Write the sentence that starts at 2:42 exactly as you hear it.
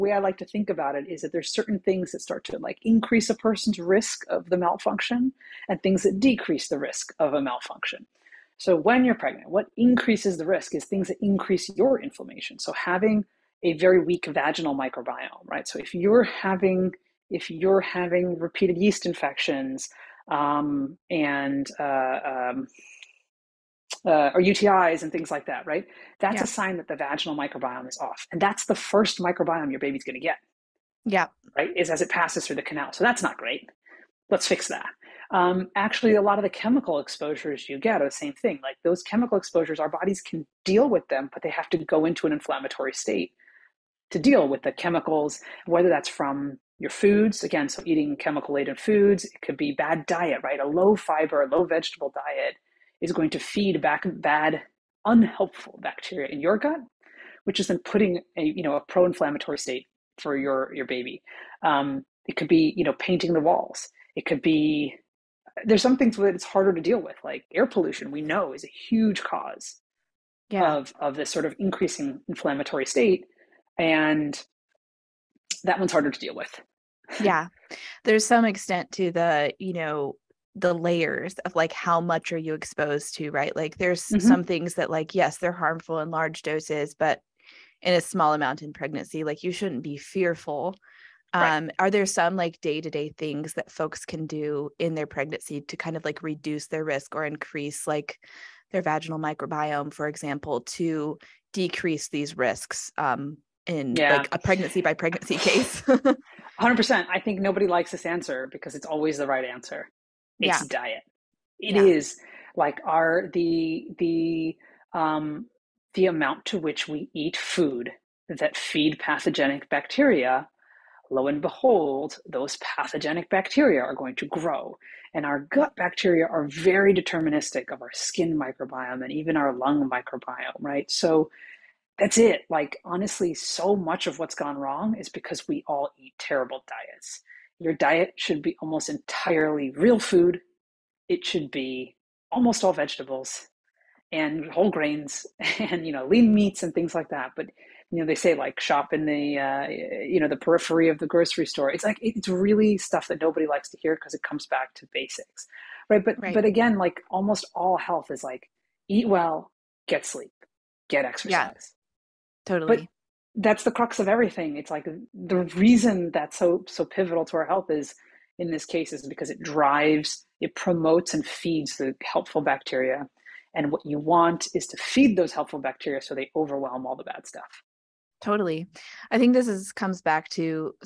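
But that's the crux of everything.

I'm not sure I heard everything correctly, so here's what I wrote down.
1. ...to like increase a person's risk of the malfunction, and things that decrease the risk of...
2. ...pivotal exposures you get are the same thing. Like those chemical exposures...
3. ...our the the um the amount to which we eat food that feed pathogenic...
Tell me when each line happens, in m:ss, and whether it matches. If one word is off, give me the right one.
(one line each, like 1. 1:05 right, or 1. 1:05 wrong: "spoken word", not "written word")
1. 0:02 right
2. 0:36 wrong: "chemical", not "pivotal"
3. 1:52 right.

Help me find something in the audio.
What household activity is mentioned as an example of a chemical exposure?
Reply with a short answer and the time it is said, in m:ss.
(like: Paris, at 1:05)
painting the walls, at 1:02.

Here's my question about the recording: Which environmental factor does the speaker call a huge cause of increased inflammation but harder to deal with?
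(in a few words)
air pollution.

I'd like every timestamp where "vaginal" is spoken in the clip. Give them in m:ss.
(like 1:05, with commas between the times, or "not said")
0:14, 0:26, 1:38.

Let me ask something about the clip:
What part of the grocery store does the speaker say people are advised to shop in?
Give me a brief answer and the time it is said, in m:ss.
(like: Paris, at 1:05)
the periphery, at 2:30.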